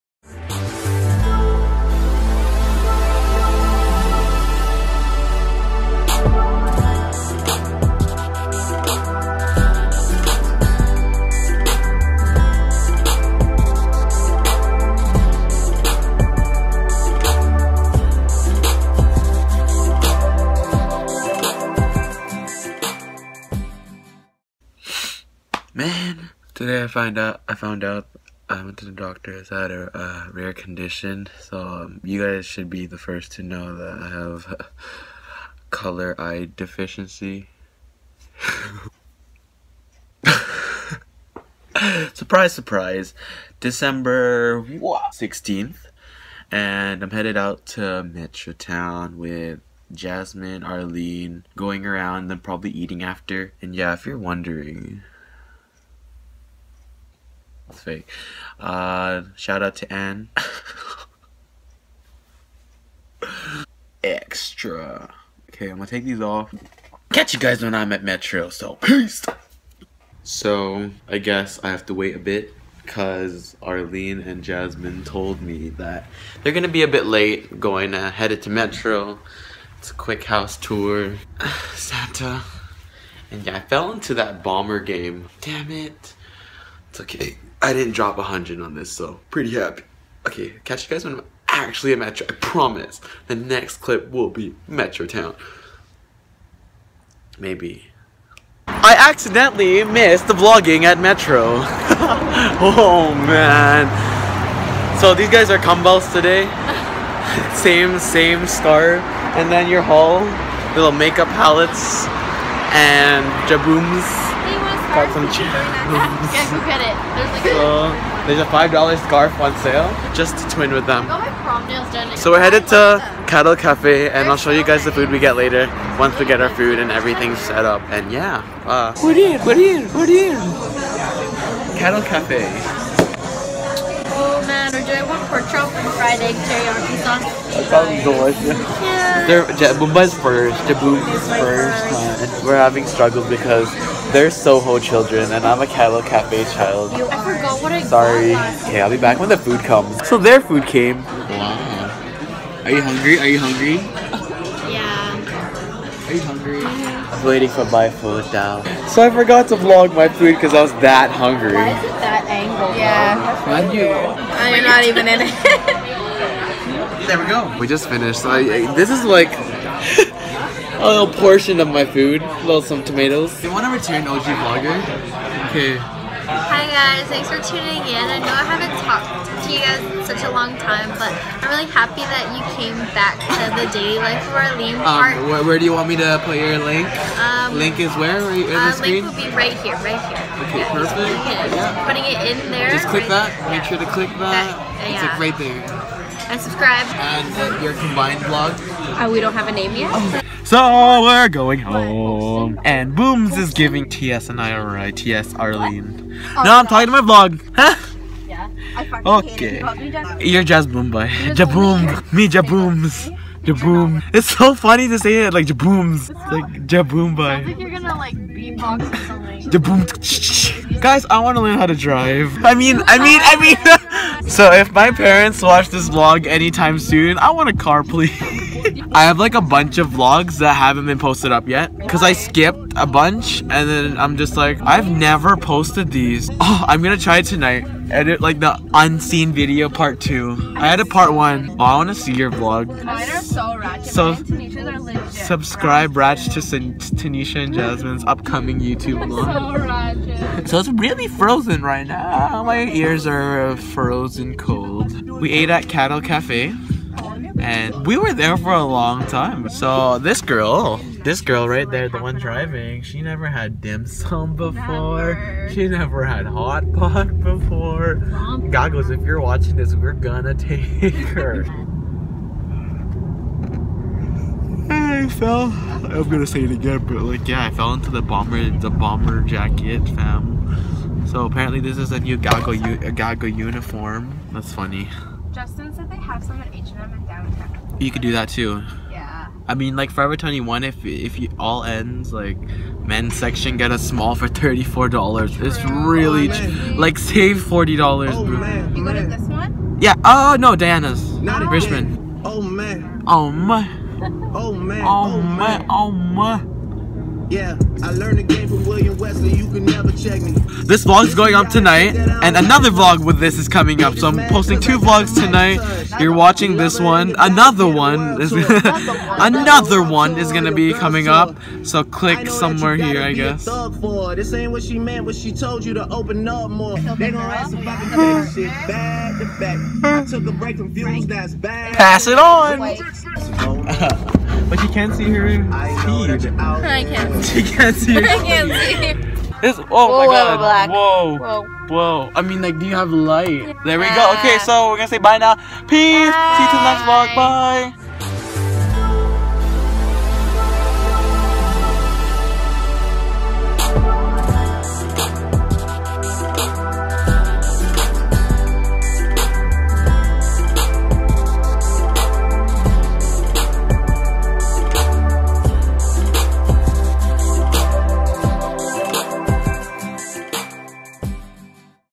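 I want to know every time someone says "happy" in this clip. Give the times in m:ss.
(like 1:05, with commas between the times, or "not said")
1:29, 3:01.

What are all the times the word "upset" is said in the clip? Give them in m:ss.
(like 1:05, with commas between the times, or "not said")
not said.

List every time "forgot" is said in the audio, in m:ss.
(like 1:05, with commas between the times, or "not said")
2:27, 2:39.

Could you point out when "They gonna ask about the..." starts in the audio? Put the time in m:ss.
5:26.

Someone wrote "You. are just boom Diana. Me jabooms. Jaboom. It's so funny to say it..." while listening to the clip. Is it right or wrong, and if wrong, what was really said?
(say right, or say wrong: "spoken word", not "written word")
wrong: "Jaboom", not "Diana".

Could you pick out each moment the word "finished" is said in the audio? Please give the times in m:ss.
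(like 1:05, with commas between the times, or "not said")
2:47.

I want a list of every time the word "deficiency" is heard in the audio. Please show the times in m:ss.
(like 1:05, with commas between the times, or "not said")
0:36.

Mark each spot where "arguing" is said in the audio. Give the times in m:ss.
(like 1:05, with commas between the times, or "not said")
not said.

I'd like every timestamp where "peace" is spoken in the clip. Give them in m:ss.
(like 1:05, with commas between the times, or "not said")
1:08, 5:45.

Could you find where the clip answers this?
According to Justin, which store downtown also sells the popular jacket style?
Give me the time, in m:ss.
4:46.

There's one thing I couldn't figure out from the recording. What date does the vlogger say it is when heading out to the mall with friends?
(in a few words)
December 16.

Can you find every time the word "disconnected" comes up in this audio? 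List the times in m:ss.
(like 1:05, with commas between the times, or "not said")
not said.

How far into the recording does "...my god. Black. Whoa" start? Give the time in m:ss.
5:39.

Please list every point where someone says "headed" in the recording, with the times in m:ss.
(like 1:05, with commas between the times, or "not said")
0:47, 1:18, 2:02.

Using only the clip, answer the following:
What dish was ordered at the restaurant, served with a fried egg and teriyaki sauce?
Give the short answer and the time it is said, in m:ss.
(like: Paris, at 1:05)
Pork chop, at 2:15.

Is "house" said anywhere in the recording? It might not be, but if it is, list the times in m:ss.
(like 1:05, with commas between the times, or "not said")
1:20.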